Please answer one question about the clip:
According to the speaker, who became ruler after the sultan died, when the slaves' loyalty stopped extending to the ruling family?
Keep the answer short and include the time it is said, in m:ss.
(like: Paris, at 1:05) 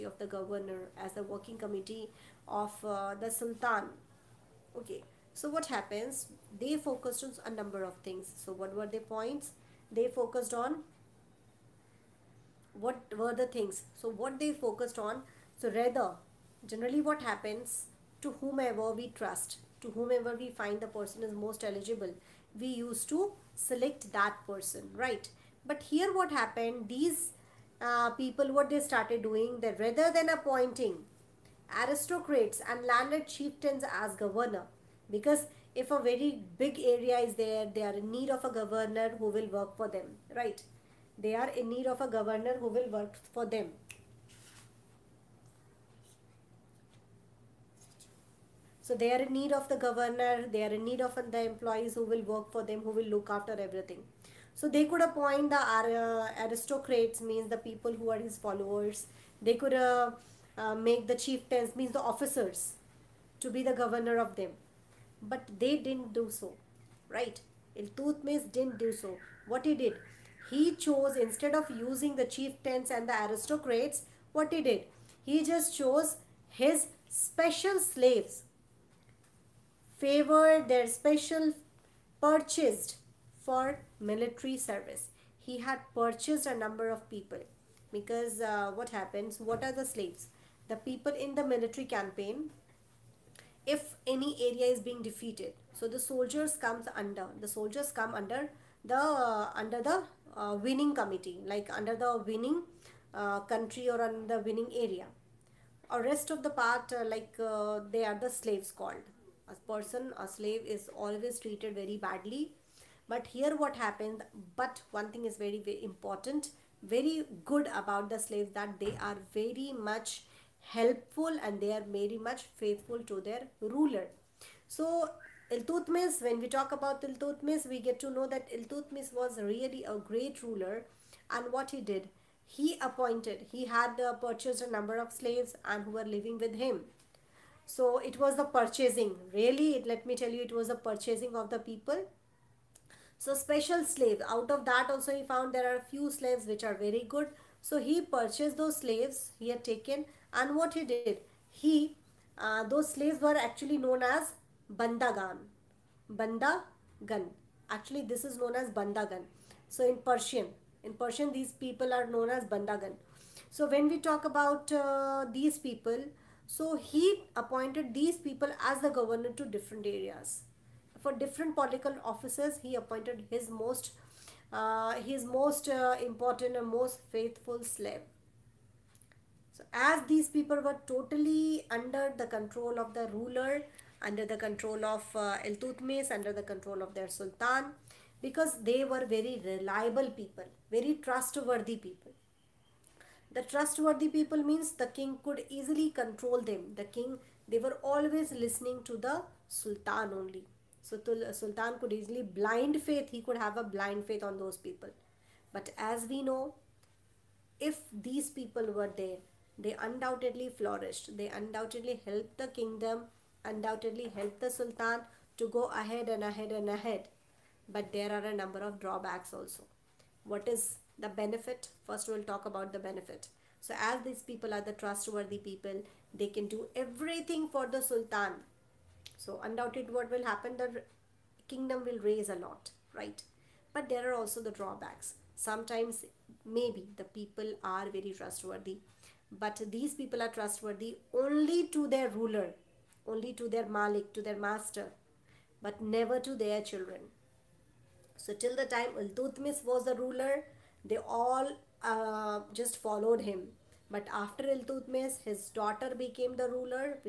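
His daughter, at 4:15.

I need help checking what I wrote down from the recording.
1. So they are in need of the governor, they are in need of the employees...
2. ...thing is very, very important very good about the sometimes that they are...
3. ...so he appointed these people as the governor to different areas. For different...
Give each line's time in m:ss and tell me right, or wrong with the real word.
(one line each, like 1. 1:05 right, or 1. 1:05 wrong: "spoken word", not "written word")
1. 0:48 right
2. 1:55 wrong: "slaves", not "sometimes"
3. 2:46 right.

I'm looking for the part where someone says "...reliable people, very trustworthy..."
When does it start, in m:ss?
3:09.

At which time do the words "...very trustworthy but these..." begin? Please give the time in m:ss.
3:57.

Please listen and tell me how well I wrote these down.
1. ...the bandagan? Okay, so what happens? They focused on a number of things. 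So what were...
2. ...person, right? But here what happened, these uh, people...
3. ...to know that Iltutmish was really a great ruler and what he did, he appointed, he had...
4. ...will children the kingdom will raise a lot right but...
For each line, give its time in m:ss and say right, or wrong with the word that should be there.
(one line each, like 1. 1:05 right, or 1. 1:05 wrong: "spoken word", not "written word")
1. 0:03 wrong: "sultan", not "bandagan"
2. 0:24 right
3. 2:08 right
4. 3:50 wrong: "happen", not "children".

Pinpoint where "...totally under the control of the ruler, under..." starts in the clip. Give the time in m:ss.
3:00.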